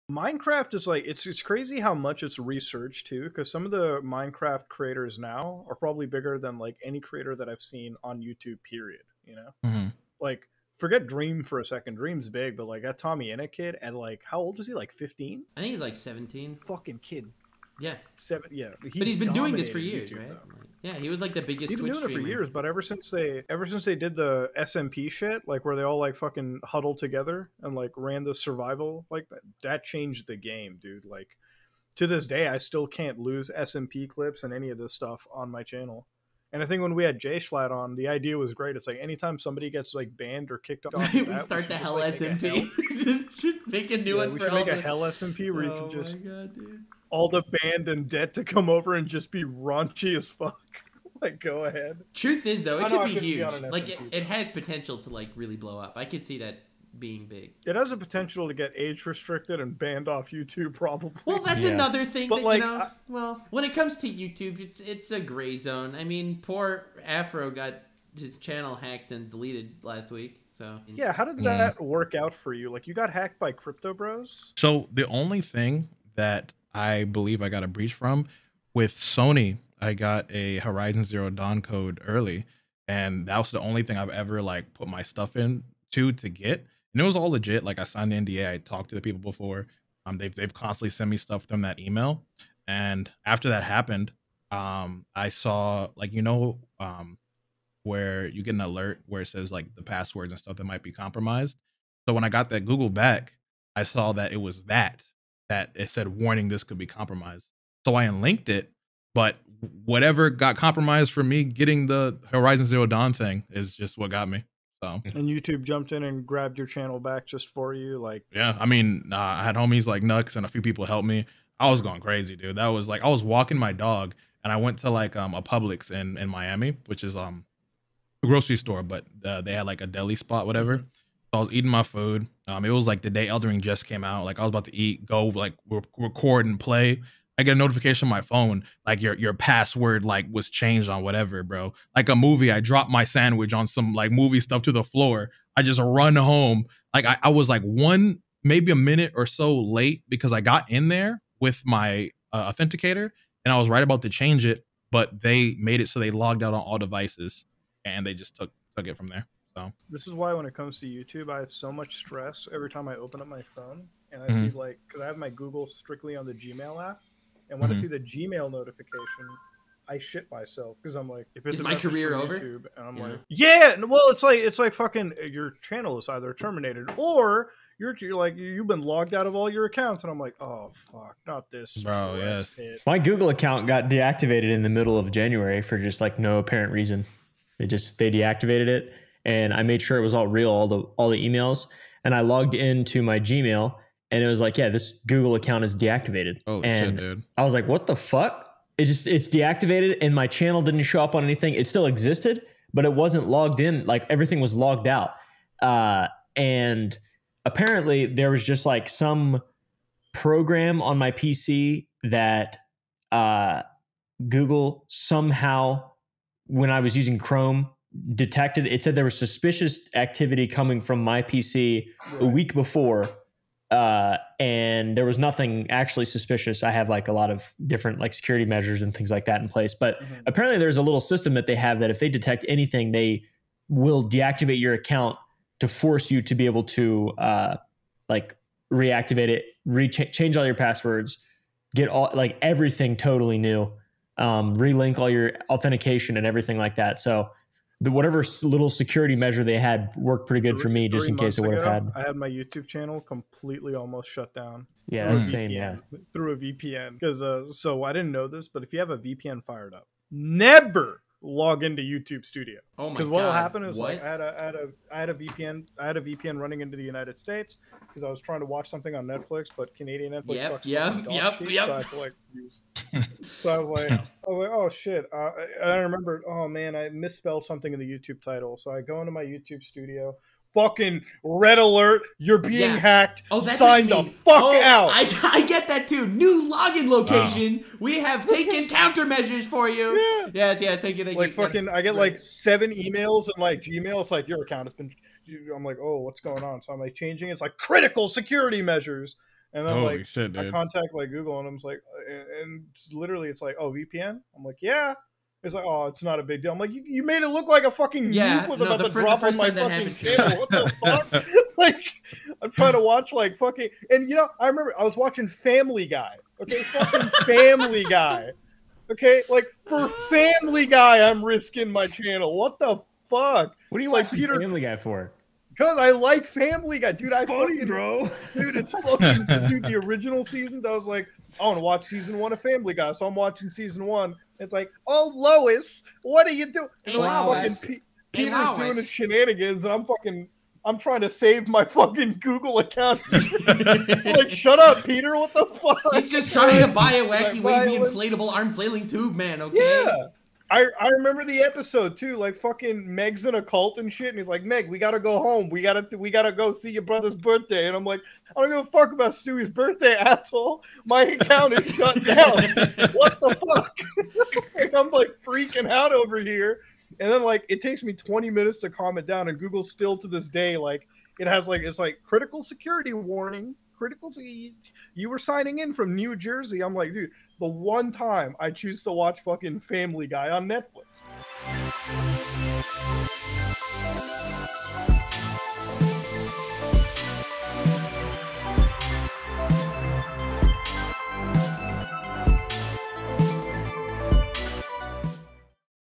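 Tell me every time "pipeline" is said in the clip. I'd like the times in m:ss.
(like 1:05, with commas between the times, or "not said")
not said.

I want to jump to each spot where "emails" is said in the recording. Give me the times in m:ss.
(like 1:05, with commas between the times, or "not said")
1:31, 3:11, 4:52.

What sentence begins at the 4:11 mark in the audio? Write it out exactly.
I had my YouTube channel completely almost shut down.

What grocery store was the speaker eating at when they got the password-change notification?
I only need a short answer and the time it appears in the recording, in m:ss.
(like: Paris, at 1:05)
Publix, at 2:05.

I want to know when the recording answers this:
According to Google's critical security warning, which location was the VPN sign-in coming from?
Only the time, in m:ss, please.
6:15.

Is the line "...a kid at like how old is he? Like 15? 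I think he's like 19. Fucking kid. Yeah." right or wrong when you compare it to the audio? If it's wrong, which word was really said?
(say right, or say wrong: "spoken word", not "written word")
wrong: "17", not "19".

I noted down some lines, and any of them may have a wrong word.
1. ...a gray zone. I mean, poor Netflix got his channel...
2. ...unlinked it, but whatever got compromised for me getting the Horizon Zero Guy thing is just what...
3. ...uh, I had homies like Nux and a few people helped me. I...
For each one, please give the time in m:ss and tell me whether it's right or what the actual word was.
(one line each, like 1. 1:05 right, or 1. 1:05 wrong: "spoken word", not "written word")
1. 1:05 wrong: "Afro", not "Netflix"
2. 1:48 wrong: "Dawn", not "Guy"
3. 1:59 right.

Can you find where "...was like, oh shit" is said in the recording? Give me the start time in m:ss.
4:34.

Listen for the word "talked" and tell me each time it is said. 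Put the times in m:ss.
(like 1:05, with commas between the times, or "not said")
1:28.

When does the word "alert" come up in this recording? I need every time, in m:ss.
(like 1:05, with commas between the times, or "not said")
1:38, 4:41.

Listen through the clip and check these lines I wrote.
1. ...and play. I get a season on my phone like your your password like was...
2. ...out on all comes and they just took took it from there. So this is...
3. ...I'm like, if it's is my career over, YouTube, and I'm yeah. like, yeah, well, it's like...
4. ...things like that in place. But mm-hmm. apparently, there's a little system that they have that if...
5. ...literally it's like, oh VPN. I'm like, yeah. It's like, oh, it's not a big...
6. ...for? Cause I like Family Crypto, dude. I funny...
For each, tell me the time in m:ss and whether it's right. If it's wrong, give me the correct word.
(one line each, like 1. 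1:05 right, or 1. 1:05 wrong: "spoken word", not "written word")
1. 2:16 wrong: "notification", not "season"
2. 2:36 wrong: "devices", not "comes"
3. 2:50 right
4. 3:48 right
5. 5:02 right
6. 5:24 wrong: "Guy", not "Crypto".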